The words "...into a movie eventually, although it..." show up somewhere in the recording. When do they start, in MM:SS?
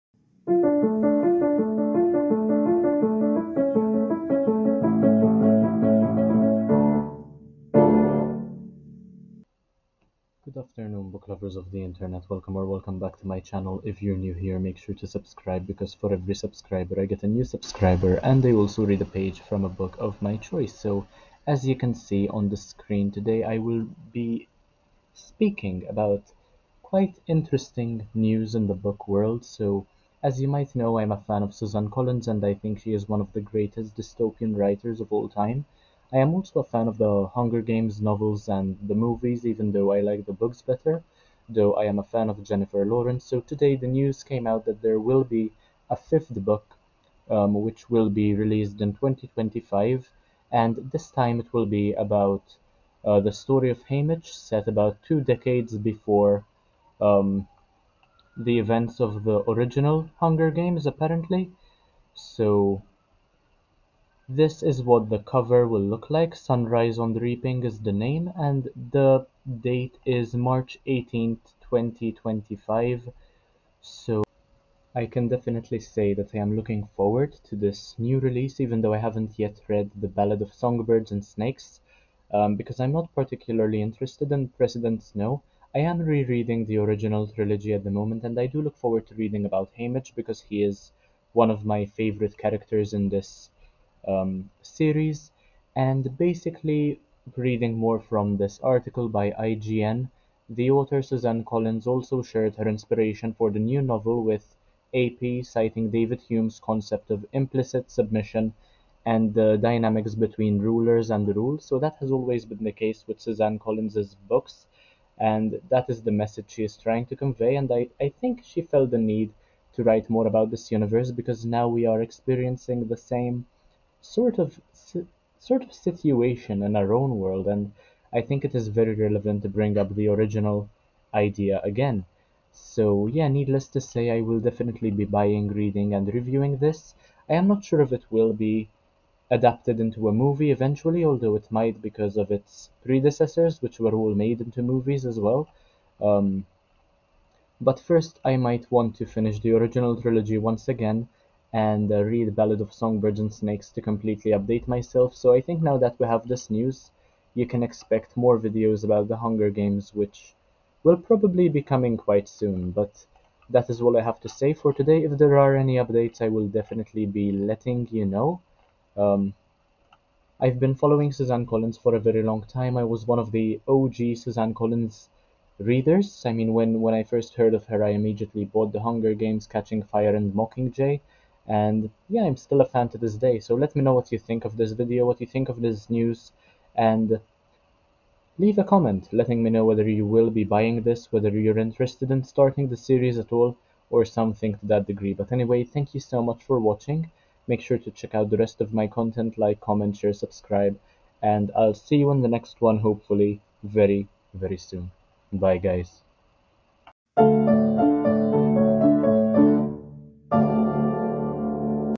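02:19.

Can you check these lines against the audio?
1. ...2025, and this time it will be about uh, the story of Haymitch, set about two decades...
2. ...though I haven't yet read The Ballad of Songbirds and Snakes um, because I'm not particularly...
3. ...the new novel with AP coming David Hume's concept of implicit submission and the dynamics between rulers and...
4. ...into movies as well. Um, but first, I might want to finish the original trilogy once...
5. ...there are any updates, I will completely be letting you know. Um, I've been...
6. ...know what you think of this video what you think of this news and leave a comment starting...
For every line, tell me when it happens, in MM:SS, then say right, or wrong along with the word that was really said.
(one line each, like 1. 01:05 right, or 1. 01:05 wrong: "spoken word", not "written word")
1. 00:48 right
2. 01:18 right
3. 01:43 wrong: "citing", not "coming"
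4. 02:24 right
5. 02:45 wrong: "definitely", not "completely"
6. 03:03 wrong: "letting", not "starting".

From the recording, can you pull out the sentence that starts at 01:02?
So this is what the cover will look like.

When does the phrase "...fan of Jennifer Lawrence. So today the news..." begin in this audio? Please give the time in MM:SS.
00:42.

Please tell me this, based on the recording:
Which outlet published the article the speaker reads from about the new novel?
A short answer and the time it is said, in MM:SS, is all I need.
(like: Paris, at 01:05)
IGN, at 01:39.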